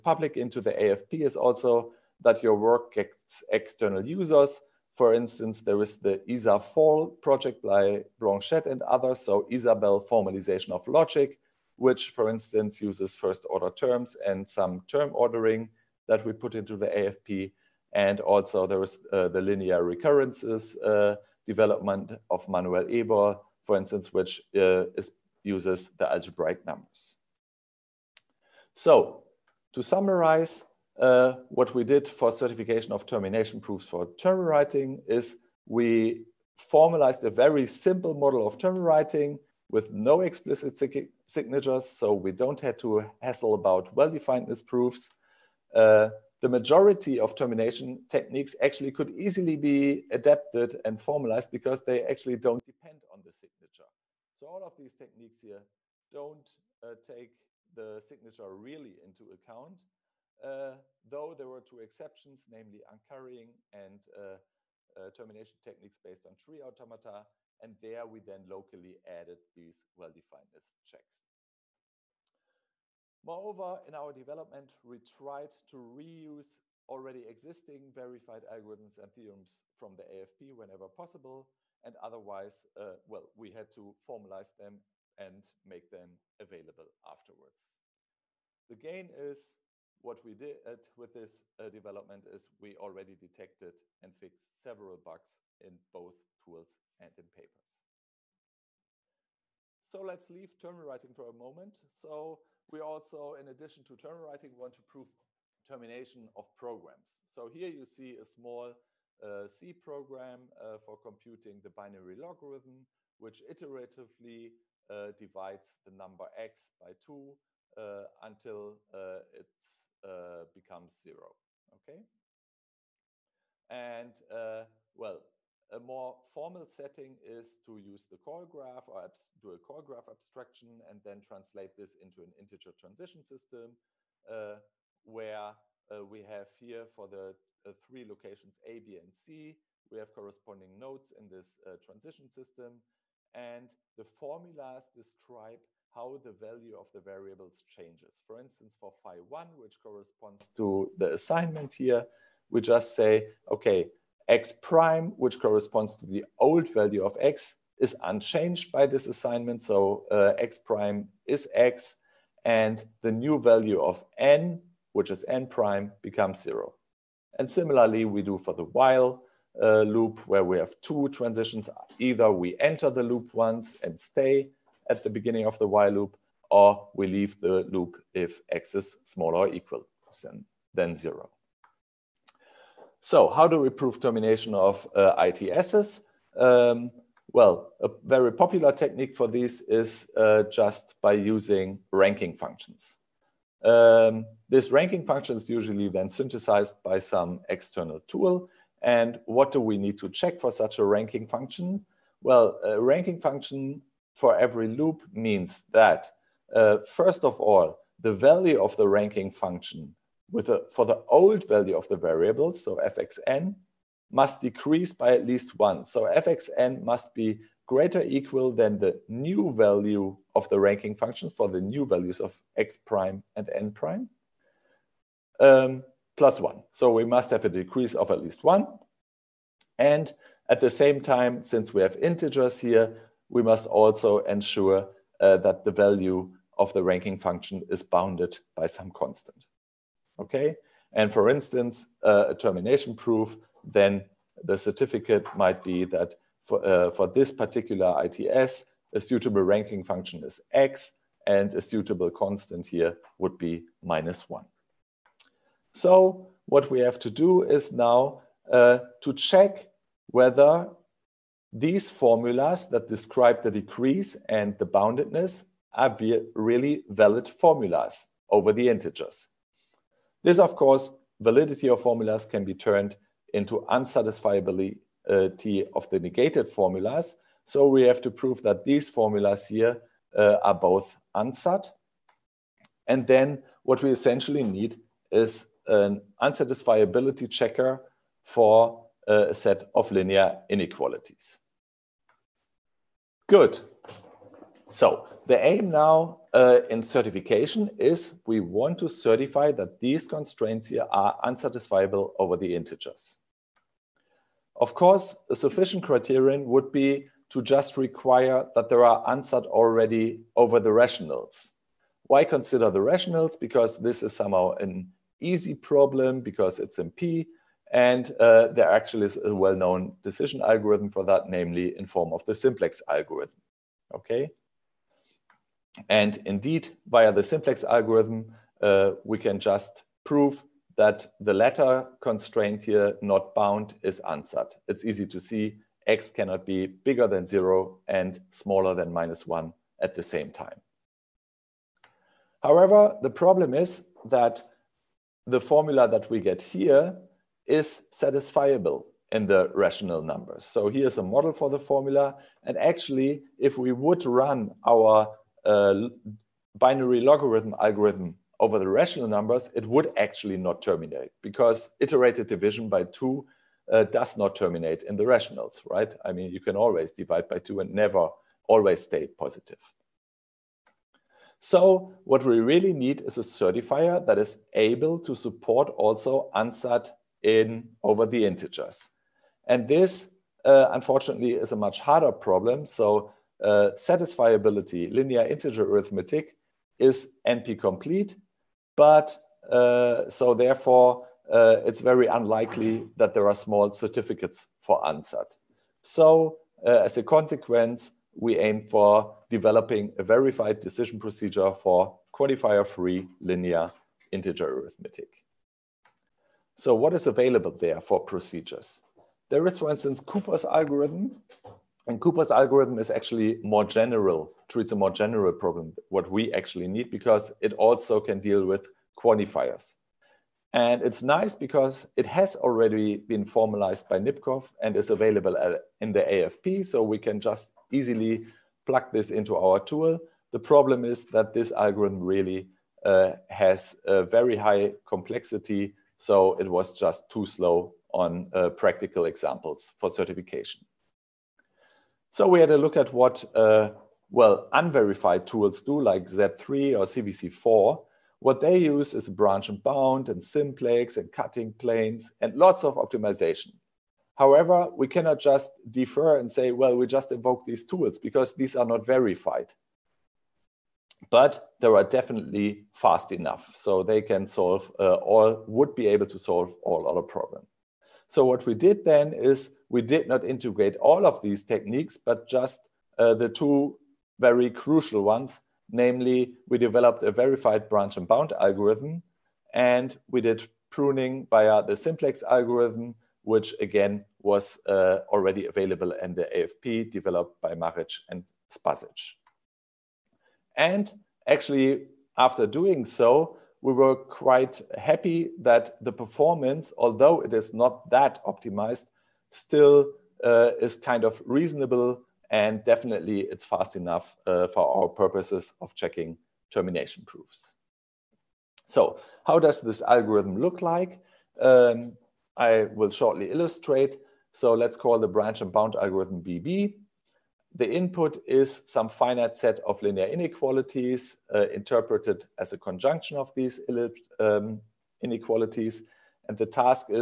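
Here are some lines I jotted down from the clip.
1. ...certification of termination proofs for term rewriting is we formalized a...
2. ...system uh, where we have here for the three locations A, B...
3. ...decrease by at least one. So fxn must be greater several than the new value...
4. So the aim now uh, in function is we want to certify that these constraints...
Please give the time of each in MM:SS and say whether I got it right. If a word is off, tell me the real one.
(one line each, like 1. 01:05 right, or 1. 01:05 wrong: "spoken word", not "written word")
1. 00:32 right
2. 02:13 right
3. 03:34 wrong: "equal", not "several"
4. 04:54 wrong: "certification", not "function".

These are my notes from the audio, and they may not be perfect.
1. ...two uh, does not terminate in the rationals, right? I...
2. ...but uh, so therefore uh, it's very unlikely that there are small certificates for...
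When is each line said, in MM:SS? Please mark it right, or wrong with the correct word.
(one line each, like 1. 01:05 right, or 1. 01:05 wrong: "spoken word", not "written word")
1. 06:02 right
2. 06:28 right.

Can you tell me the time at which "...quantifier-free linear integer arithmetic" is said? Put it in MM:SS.
06:42.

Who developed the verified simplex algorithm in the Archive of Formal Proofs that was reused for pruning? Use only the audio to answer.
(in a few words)
Maric and Spasic.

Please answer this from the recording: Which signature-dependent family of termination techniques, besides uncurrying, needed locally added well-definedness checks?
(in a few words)
tree automata.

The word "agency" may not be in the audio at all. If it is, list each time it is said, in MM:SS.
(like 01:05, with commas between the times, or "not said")
not said.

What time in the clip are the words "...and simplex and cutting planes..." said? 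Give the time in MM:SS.
07:30.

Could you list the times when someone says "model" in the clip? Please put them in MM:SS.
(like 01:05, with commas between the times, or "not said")
00:38, 05:51.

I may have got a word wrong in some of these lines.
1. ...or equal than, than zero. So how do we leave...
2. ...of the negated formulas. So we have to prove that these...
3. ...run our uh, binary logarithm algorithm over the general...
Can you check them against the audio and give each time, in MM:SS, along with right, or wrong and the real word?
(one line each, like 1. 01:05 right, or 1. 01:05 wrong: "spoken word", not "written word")
1. 02:59 wrong: "prove", not "leave"
2. 04:35 right
3. 05:54 wrong: "rational", not "general".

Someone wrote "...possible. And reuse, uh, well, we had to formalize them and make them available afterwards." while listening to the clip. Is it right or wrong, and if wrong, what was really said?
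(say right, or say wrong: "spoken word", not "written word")
wrong: "otherwise", not "reuse".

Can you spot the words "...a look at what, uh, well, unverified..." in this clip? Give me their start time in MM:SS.
07:22.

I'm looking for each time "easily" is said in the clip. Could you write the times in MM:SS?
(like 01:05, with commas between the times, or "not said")
00:49, 07:07.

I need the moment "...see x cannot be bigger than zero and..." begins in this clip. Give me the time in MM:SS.
05:35.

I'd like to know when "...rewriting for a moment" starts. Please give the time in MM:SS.
01:40.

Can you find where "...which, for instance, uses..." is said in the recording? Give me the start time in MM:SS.
00:11.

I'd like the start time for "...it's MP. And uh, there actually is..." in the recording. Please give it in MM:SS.
05:16.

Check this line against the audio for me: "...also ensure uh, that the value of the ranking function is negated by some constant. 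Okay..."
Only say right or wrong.
wrong.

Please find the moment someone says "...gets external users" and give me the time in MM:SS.
00:02.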